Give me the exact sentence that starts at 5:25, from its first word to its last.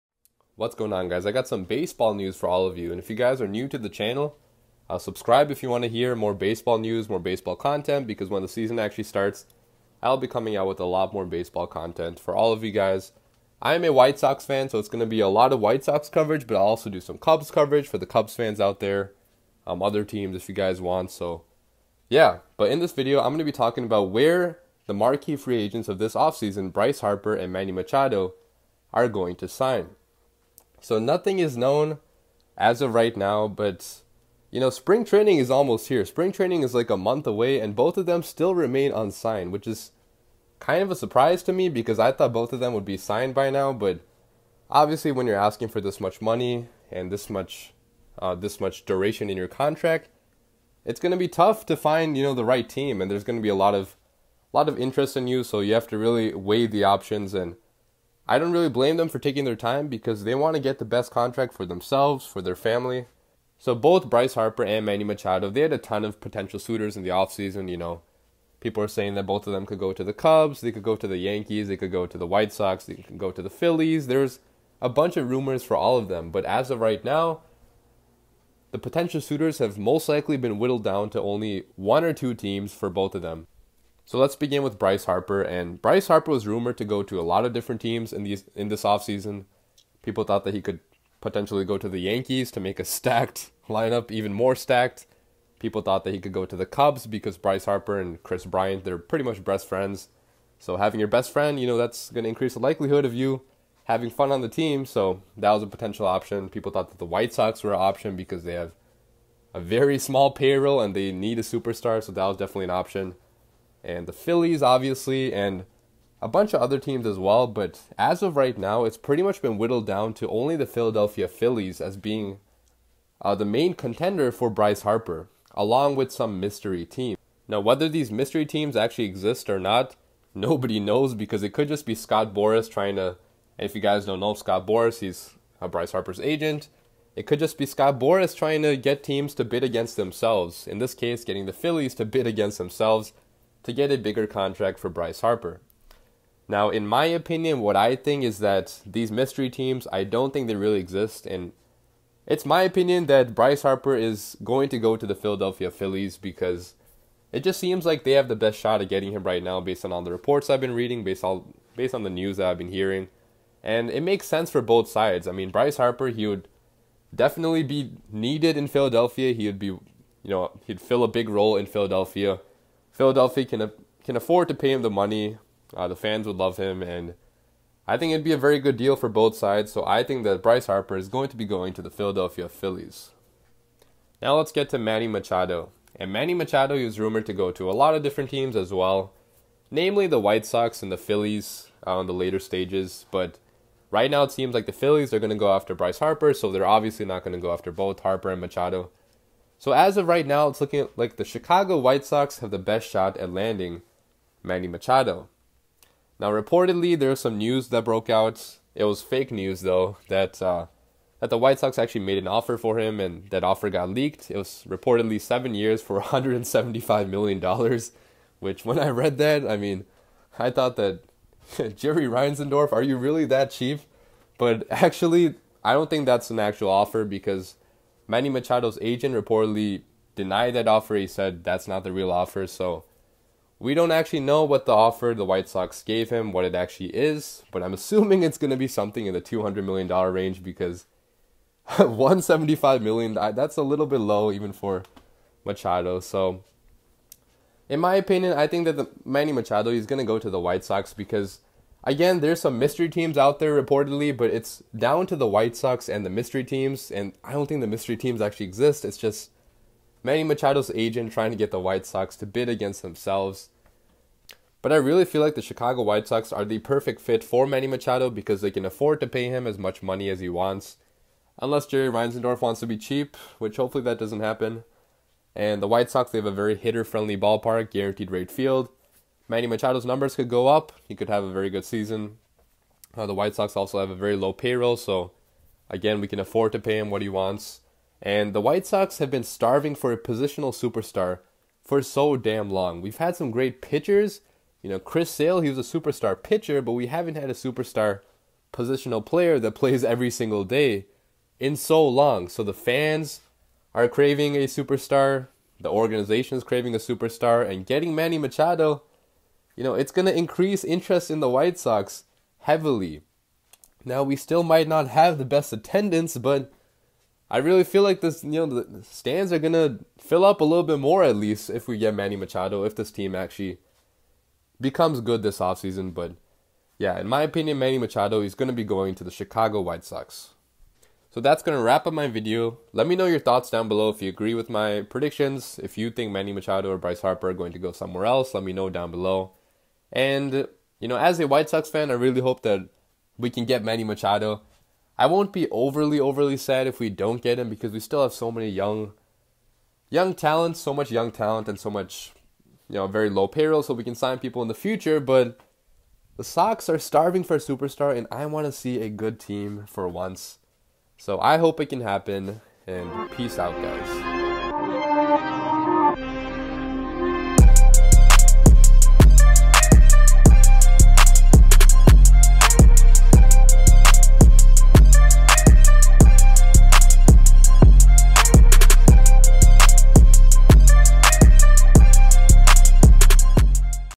But yeah, in my opinion, Manny Machado is going to be going to the Chicago White Sox.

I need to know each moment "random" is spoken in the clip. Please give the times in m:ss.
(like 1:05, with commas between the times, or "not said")
not said.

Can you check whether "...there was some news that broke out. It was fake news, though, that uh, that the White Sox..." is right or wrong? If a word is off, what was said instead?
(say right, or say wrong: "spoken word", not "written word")
right.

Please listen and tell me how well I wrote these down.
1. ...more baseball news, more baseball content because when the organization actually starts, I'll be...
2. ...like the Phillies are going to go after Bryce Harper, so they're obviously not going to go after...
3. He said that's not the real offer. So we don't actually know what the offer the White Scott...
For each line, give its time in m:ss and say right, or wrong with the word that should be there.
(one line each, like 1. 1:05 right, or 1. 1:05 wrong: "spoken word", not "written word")
1. 0:06 wrong: "season", not "organization"
2. 3:14 right
3. 3:50 wrong: "Sox", not "Scott".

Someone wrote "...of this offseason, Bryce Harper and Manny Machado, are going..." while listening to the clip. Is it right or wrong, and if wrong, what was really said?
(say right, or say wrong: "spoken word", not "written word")
right.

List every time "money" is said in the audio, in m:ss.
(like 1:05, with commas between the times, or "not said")
0:46, 2:54, 4:29.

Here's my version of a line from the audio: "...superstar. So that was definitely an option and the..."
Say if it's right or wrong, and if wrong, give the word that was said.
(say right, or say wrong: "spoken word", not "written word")
right.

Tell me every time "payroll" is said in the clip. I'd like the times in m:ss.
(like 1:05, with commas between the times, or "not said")
1:50, 4:44, 5:53.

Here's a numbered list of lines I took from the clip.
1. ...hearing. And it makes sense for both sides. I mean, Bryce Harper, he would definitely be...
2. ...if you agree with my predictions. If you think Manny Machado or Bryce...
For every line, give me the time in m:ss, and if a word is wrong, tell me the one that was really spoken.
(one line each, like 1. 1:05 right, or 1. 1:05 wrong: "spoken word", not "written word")
1. 2:42 right
2. 5:33 right.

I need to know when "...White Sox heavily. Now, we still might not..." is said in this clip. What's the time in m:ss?
5:11.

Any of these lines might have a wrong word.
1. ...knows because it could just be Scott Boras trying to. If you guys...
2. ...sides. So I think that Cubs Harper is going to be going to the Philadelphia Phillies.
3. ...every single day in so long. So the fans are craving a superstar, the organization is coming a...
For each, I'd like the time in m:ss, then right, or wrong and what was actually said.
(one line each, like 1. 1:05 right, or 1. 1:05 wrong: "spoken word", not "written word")
1. 2:10 right
2. 2:59 wrong: "Bryce", not "Cubs"
3. 4:59 wrong: "craving", not "coming".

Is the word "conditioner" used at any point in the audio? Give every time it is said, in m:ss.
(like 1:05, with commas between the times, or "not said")
not said.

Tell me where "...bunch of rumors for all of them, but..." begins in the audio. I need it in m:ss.
1:14.